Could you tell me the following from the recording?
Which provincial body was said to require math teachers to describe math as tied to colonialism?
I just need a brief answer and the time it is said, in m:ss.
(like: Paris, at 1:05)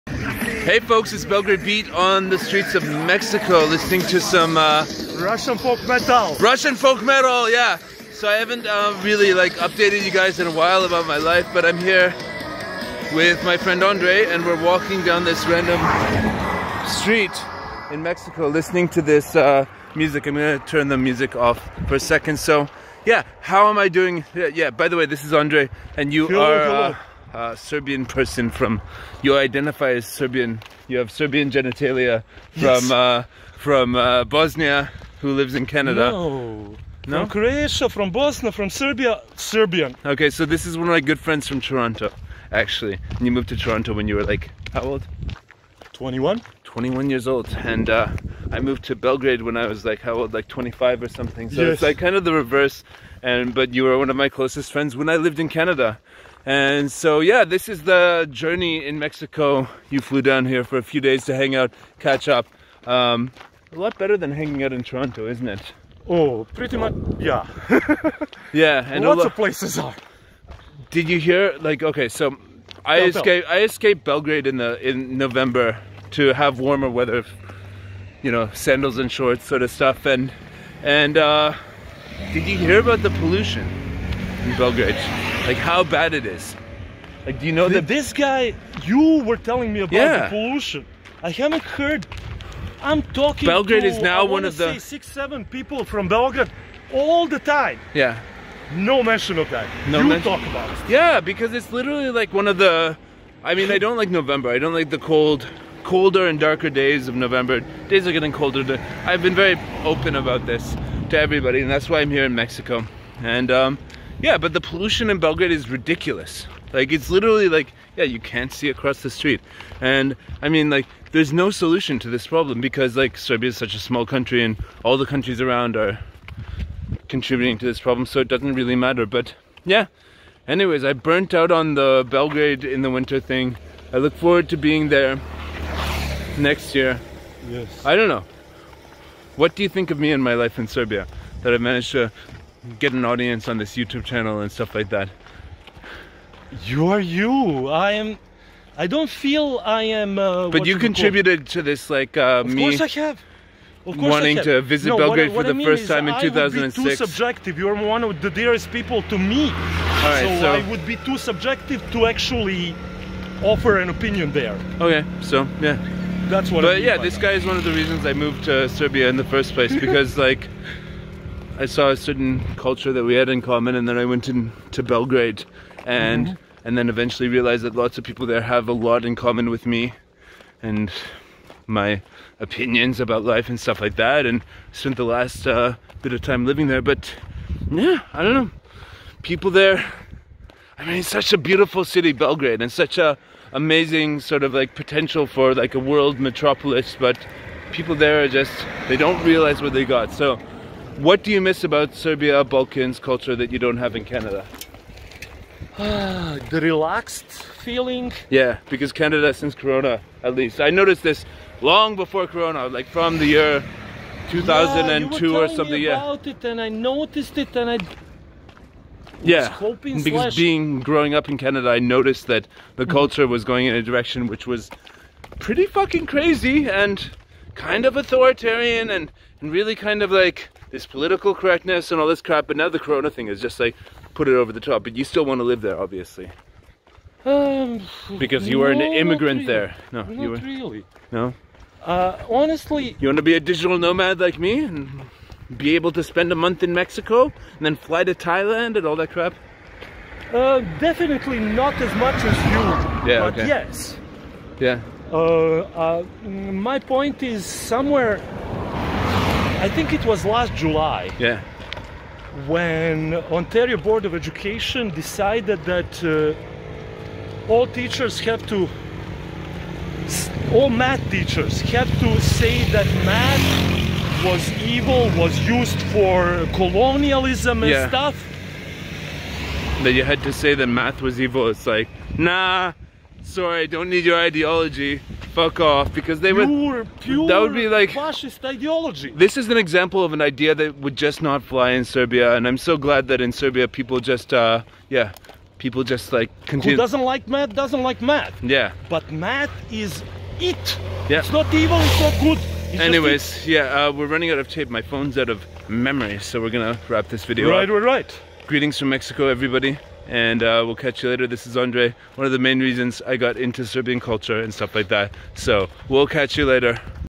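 Ontario Board of Education, at 4:23.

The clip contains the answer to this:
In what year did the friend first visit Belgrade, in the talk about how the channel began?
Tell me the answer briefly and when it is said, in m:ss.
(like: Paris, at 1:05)
2006, at 2:36.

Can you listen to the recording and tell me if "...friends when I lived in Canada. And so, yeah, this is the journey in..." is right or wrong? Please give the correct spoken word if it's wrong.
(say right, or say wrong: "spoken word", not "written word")
right.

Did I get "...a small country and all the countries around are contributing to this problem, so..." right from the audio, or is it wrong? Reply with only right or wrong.
right.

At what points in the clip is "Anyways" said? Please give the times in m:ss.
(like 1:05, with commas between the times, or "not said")
2:10, 5:02.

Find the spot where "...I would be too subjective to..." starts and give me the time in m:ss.
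2:40.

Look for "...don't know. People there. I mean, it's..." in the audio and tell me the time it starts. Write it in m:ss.
3:08.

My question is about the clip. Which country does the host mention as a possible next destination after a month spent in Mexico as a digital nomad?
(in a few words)
Thailand.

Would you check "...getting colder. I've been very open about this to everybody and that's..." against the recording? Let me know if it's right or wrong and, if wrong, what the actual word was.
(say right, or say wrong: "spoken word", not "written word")
right.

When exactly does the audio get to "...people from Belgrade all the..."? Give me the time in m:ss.
1:35.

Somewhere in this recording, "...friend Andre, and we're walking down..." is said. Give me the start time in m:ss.
0:13.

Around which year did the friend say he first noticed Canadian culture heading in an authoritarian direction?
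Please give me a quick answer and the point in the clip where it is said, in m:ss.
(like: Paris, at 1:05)
2002, at 3:34.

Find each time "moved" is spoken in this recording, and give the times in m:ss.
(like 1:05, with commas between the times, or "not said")
0:43, 0:48, 2:48.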